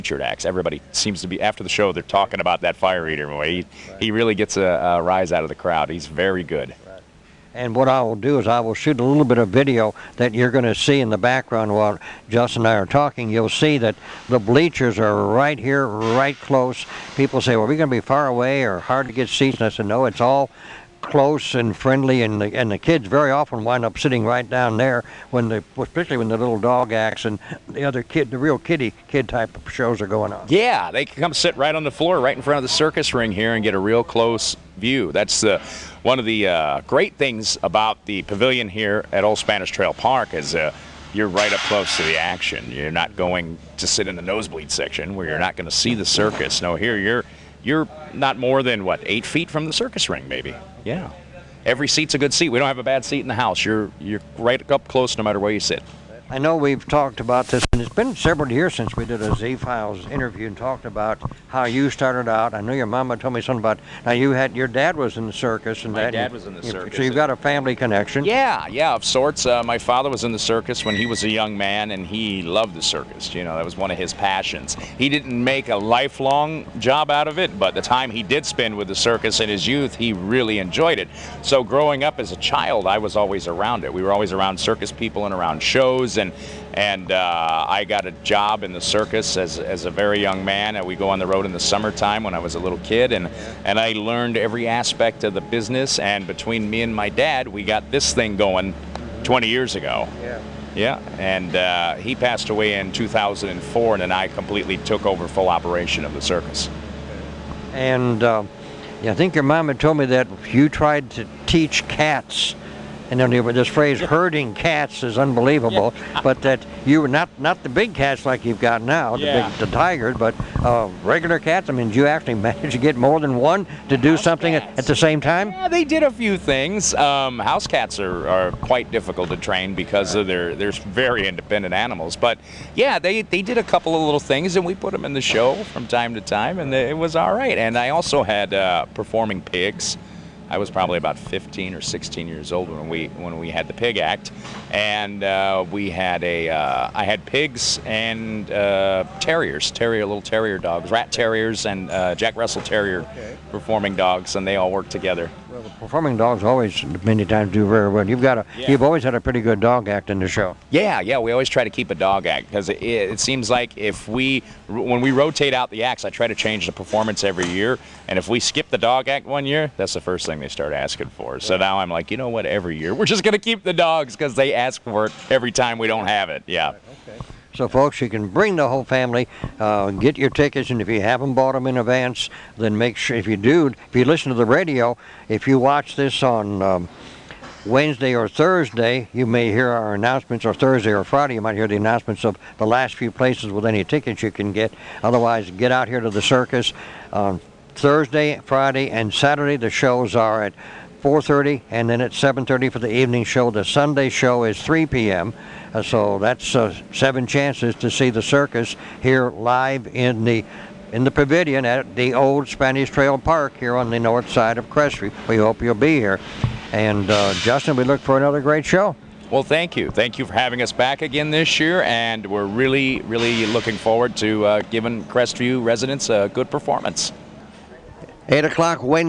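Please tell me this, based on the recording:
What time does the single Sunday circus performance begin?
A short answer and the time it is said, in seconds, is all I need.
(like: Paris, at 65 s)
3 p.m., at 204 s.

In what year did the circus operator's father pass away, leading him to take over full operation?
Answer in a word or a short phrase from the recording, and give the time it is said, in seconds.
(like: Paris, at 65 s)
2004, at 102 s.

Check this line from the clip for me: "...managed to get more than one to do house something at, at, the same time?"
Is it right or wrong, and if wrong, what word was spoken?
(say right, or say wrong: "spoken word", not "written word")
right.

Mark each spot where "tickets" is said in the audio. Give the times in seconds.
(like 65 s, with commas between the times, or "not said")
180 s, 193 s.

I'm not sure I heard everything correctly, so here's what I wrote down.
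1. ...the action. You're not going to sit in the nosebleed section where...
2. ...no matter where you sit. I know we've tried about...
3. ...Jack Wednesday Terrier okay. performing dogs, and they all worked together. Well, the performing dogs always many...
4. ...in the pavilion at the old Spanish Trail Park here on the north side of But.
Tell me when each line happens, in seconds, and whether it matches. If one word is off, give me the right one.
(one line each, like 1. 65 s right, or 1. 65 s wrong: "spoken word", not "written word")
1. 42 s right
2. 55 s wrong: "talked", not "tried"
3. 152 s wrong: "Russell", not "Wednesday"
4. 210 s wrong: "Crestview", not "But".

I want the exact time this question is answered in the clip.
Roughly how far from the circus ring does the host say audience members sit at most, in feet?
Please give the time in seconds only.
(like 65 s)
49 s.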